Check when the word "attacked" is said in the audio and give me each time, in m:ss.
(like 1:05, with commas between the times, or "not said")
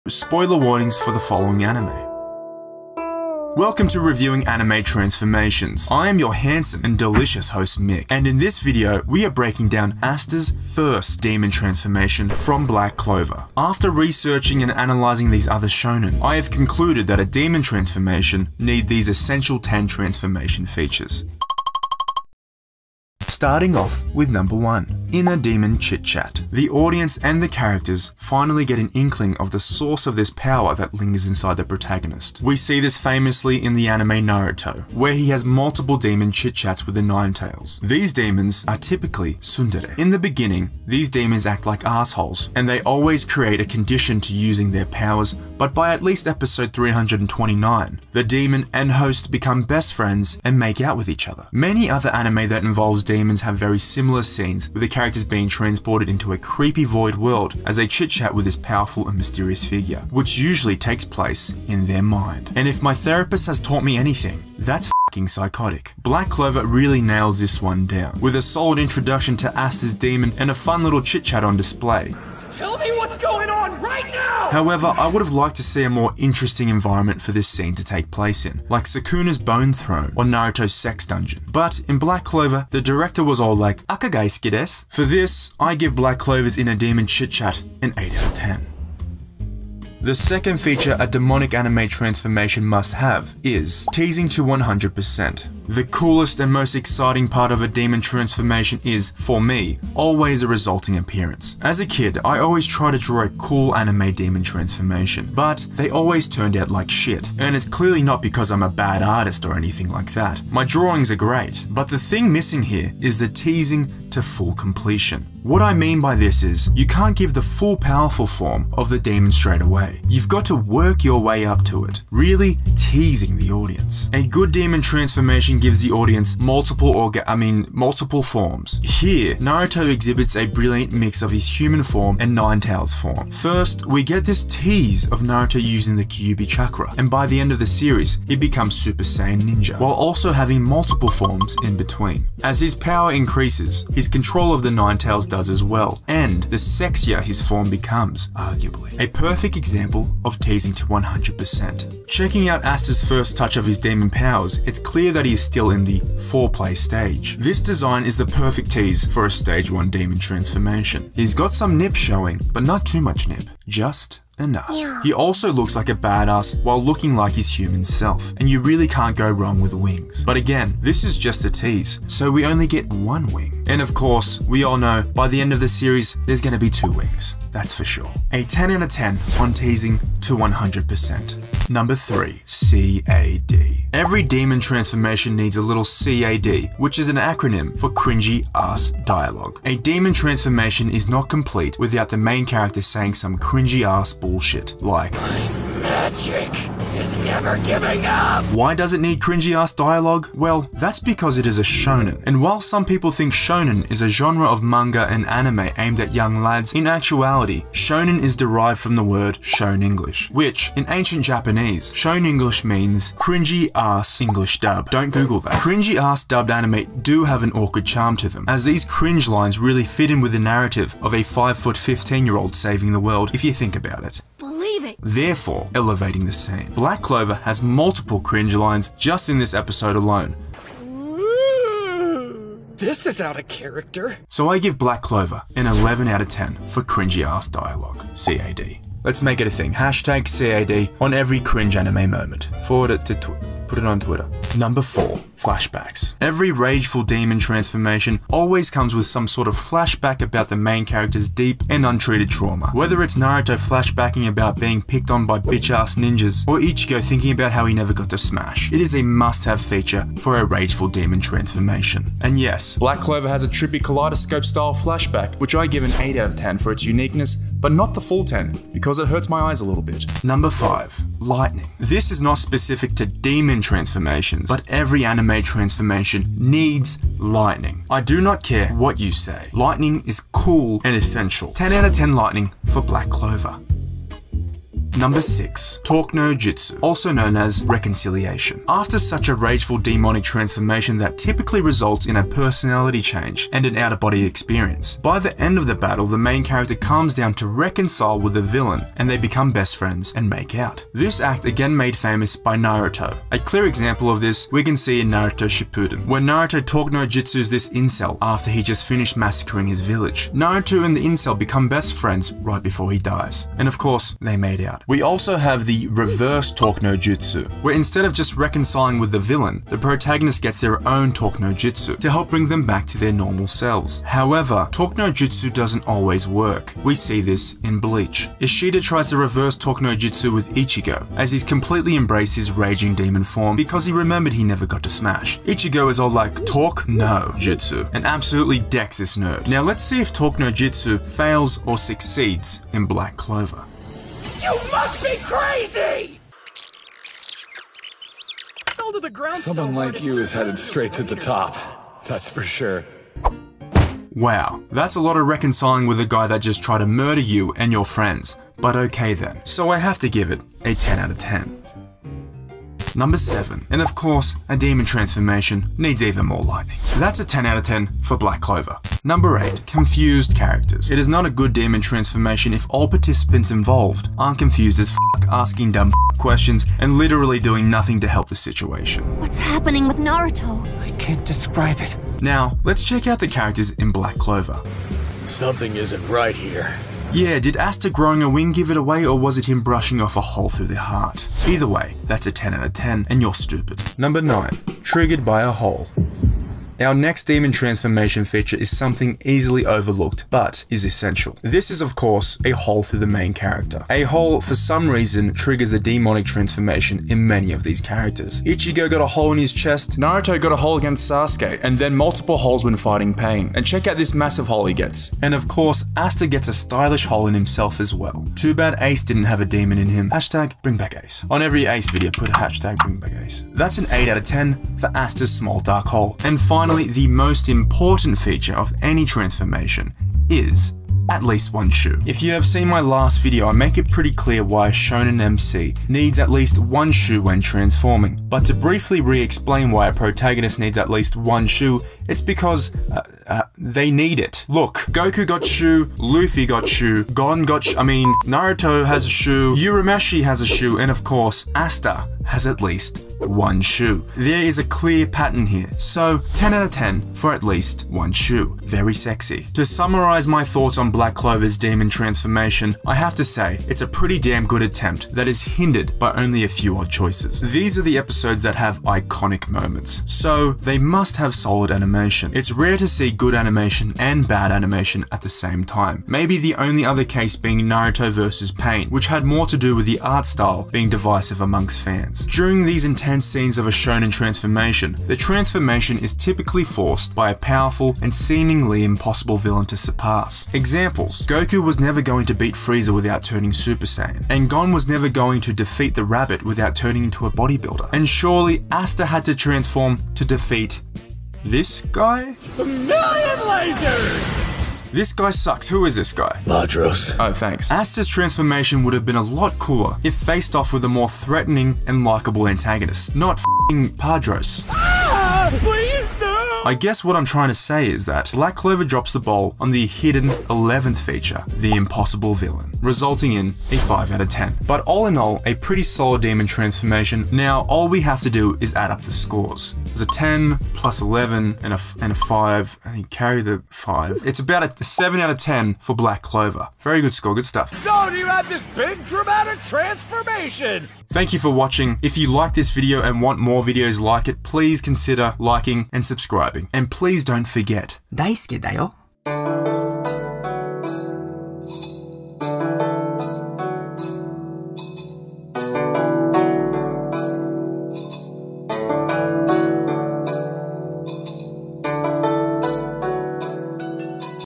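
not said.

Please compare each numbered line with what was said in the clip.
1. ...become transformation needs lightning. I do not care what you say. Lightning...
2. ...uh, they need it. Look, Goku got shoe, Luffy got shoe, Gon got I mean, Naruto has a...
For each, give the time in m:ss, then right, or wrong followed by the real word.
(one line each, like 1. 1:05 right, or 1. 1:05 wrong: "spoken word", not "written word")
1. 4:35 wrong: "anime", not "become"
2. 7:23 right.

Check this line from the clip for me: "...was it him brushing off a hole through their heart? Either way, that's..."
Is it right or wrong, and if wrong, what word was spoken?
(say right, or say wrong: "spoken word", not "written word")
right.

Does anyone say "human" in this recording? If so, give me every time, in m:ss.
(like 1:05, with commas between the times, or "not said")
2:11, 2:47.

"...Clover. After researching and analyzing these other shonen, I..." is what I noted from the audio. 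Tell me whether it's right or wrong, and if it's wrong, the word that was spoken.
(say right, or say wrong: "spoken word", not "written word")
right.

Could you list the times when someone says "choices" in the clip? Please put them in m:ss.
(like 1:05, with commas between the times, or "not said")
7:46.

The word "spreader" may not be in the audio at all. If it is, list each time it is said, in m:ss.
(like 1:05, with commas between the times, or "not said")
not said.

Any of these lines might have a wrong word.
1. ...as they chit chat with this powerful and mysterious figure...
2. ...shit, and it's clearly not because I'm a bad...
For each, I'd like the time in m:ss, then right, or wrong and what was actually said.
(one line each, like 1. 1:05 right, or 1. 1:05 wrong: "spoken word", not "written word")
1. 0:57 right
2. 1:46 right.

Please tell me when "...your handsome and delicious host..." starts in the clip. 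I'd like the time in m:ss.
0:06.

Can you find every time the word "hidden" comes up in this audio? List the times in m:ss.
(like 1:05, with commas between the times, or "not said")
8:39.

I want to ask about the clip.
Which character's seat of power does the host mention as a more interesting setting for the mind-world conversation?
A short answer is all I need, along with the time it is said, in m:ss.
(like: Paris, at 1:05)
Sukuna's Bone Throne, at 1:18.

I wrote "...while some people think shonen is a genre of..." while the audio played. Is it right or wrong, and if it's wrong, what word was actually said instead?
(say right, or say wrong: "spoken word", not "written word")
right.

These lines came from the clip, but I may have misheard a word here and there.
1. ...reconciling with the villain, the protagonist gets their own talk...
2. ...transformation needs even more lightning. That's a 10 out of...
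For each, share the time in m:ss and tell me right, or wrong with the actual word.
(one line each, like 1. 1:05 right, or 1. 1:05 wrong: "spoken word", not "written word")
1. 5:18 right
2. 6:04 right.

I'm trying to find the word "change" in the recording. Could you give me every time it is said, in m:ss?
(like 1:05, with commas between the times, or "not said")
4:53.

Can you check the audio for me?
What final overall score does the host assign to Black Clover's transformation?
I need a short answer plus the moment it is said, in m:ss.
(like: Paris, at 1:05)
7 out of 10, at 8:54.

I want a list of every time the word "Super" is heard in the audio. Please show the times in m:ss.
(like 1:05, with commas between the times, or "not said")
2:18, 8:13.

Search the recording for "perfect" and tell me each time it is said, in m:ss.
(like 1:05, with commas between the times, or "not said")
2:29, 2:38.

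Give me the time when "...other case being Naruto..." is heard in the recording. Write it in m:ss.
7:56.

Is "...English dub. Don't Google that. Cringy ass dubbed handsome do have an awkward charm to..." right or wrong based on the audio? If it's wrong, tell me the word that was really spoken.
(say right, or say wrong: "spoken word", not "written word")
wrong: "anime", not "handsome".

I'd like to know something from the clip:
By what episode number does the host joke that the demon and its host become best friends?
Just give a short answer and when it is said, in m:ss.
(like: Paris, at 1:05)
329, at 0:46.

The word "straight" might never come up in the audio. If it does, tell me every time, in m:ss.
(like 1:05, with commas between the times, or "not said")
1:59, 5:50.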